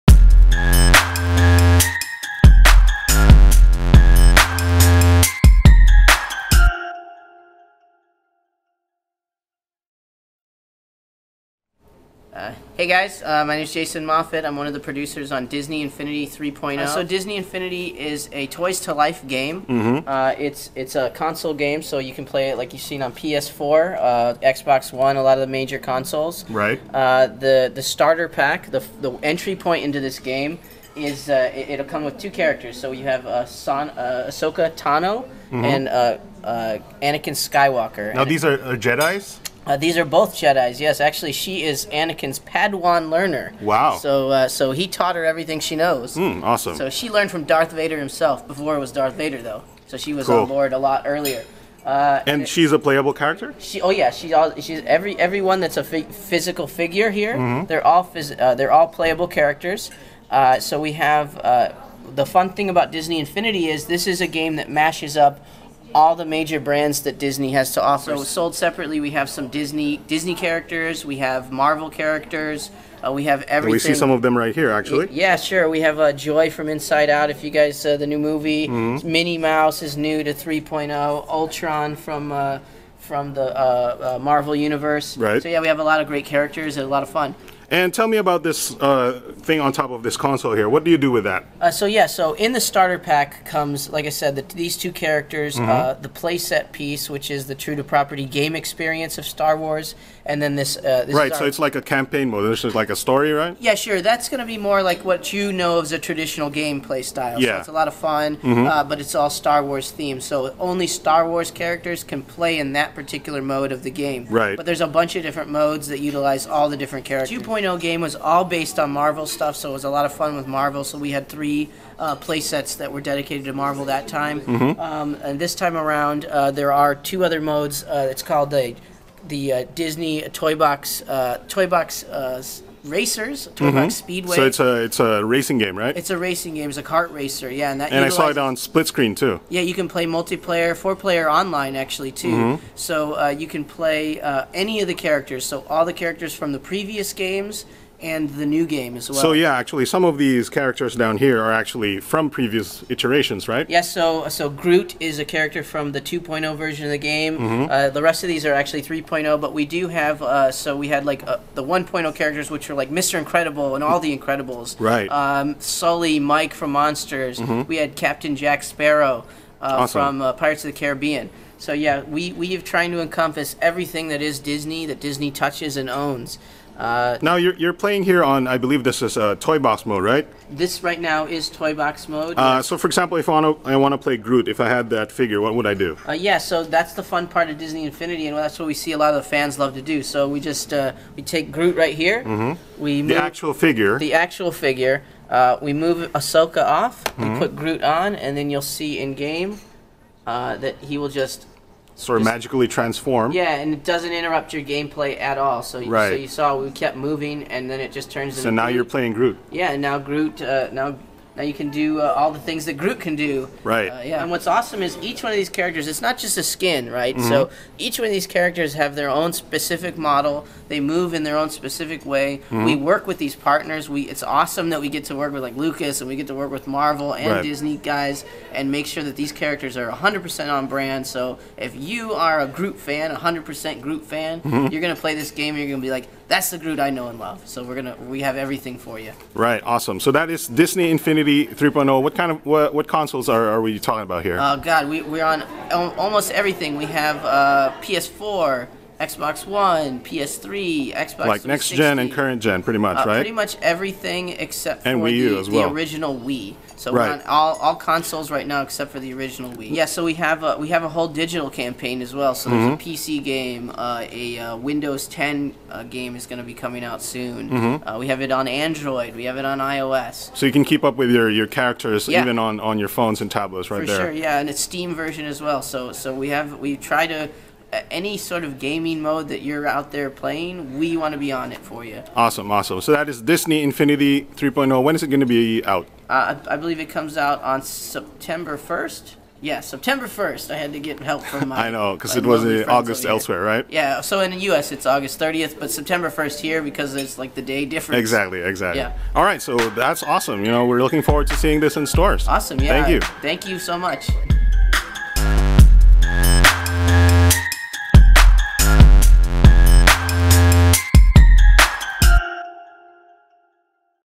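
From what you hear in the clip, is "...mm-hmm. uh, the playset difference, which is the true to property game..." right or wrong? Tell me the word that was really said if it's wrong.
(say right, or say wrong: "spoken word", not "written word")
wrong: "piece", not "difference".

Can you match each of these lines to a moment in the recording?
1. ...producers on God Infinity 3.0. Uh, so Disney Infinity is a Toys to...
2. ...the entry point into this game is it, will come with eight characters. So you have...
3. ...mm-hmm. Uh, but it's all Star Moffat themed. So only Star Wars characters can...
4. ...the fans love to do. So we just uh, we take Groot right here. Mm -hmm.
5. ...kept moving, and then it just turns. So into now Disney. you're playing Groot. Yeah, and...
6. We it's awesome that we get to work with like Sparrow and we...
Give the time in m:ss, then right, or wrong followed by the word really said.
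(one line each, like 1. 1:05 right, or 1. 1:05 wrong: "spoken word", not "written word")
1. 0:14 wrong: "Disney", not "God"
2. 0:29 wrong: "two", not "eight"
3. 1:48 wrong: "Wars", not "Moffat"
4. 3:09 right
5. 3:26 wrong: "Groot", not "Disney"
6. 3:43 wrong: "Lucas", not "Sparrow".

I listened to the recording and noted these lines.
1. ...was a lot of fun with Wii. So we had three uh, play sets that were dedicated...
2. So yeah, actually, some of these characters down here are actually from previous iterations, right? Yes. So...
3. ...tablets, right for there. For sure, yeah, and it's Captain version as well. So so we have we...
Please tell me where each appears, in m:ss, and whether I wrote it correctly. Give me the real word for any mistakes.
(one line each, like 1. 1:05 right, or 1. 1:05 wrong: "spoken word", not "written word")
1. 1:59 wrong: "Marvel", not "Wii"
2. 2:29 right
3. 4:33 wrong: "Steam", not "Captain".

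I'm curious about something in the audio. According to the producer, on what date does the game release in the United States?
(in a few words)
August 30th.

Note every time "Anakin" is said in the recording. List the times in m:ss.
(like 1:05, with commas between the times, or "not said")
0:36, 0:41.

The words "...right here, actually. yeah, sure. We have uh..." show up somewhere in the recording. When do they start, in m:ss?
1:14.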